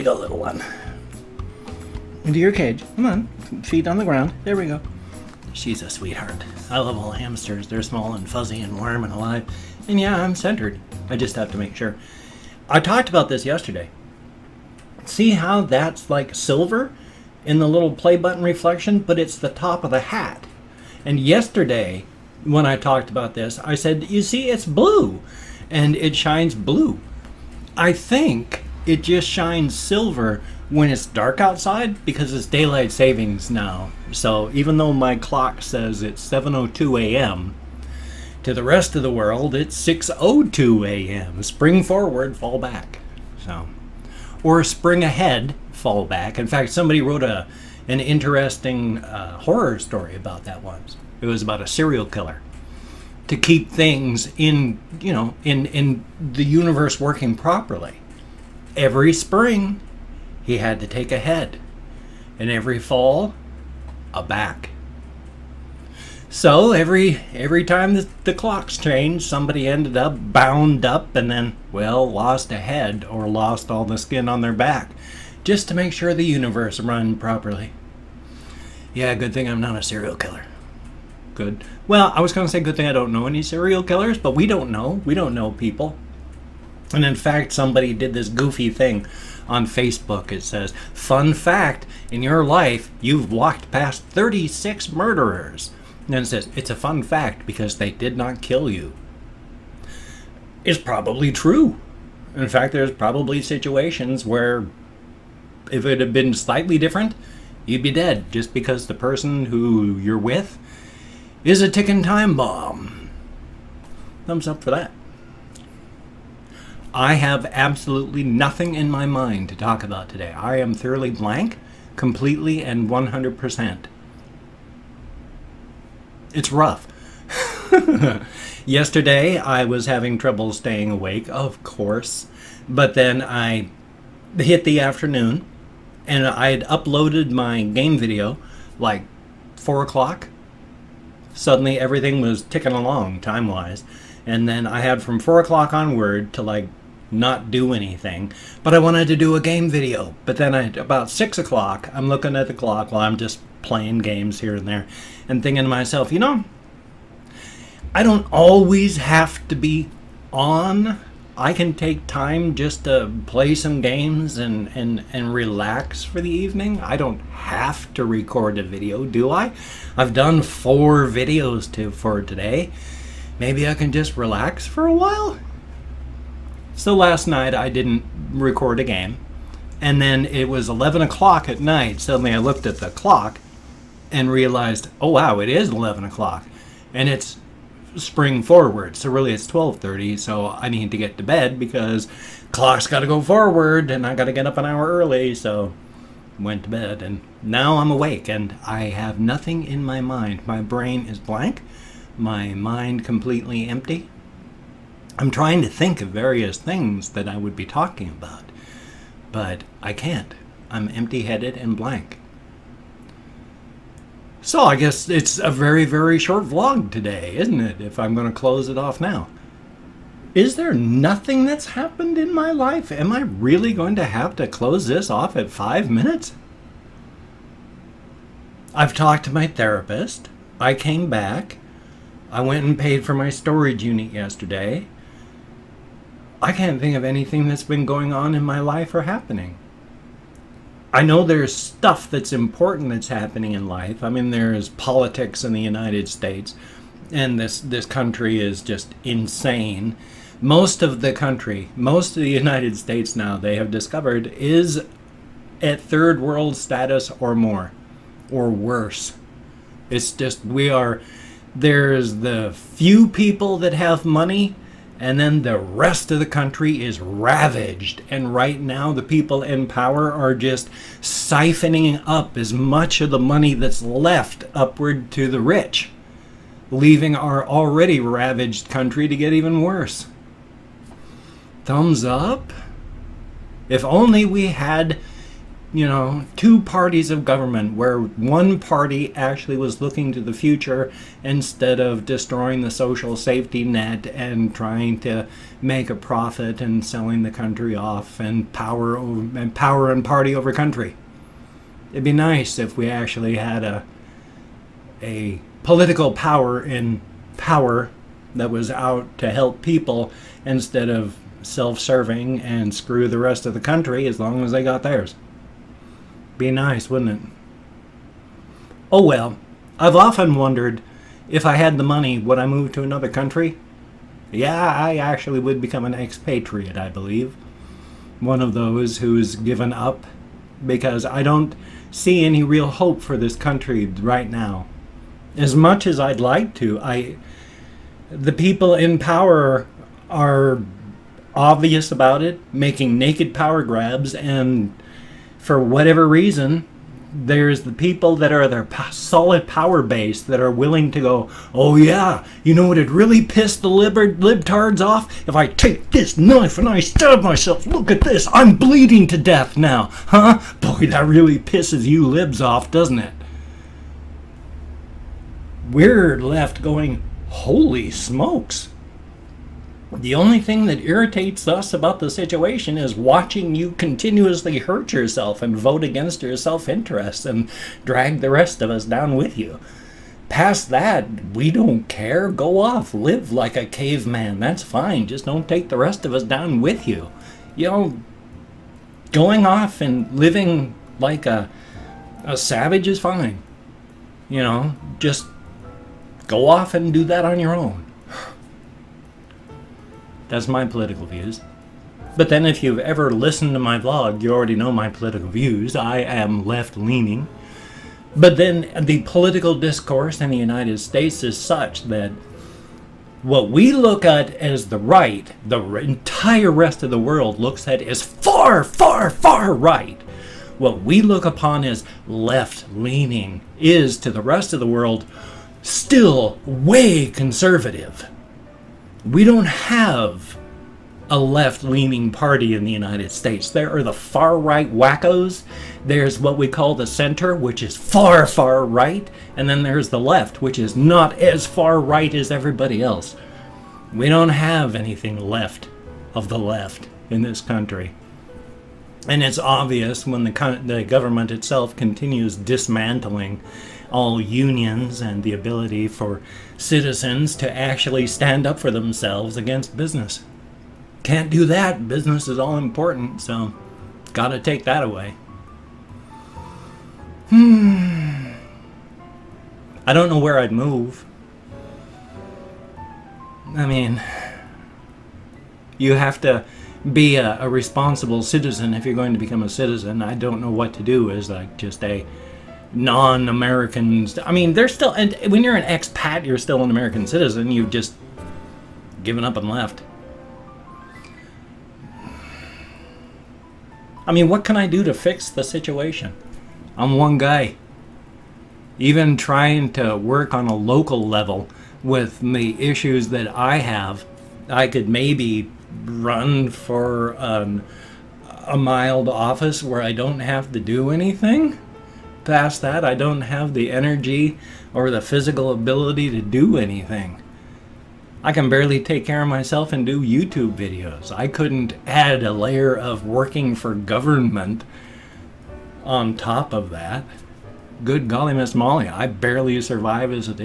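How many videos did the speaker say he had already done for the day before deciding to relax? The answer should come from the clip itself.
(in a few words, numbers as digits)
4.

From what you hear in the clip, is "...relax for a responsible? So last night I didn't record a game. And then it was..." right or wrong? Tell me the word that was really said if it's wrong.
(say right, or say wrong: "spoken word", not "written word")
wrong: "while", not "responsible".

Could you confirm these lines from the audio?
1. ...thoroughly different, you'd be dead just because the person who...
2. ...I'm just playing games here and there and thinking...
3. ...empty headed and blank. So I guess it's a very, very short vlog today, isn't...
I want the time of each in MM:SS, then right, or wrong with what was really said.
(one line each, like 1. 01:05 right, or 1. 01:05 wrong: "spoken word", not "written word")
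1. 01:46 wrong: "slightly", not "thoroughly"
2. 02:33 right
3. 03:30 right.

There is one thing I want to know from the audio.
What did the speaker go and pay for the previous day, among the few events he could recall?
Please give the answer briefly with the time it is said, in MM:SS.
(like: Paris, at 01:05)
storage unit, at 03:53.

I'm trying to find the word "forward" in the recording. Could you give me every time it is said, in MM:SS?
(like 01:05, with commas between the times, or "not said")
00:41, 03:08, 03:13.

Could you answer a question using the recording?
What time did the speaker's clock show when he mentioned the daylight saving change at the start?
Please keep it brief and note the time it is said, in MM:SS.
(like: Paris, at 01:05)
7:02 a.m., at 00:36.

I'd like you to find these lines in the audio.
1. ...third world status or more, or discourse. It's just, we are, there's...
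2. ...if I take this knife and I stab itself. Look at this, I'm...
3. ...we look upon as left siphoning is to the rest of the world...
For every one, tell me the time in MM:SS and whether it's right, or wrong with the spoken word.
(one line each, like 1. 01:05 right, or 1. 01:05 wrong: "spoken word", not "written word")
1. 04:15 wrong: "worse", not "discourse"
2. 05:55 wrong: "myself", not "itself"
3. 07:00 wrong: "leaning", not "siphoning".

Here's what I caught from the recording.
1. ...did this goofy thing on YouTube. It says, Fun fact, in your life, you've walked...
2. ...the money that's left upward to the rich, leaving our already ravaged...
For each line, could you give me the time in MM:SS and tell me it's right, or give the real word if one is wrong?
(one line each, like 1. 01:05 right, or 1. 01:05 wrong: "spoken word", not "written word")
1. 01:27 wrong: "Facebook", not "YouTube"
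2. 04:33 right.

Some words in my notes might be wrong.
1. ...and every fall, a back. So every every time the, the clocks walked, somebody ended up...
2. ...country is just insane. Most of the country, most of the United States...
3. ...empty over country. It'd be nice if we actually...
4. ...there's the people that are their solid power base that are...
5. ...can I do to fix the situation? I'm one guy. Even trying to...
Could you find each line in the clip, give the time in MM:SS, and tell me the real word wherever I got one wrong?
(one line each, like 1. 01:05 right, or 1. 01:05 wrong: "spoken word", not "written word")
1. 01:02 wrong: "changed", not "walked"
2. 04:07 right
3. 05:00 wrong: "party", not "empty"
4. 05:47 right
5. 08:14 right.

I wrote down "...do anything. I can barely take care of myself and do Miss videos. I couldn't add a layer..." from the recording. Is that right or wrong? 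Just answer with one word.
wrong.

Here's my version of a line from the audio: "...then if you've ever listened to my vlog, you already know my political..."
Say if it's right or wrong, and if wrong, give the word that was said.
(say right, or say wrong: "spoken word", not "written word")
right.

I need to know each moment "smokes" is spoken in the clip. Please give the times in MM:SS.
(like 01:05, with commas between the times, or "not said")
06:07.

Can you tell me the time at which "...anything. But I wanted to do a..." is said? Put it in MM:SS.
02:27.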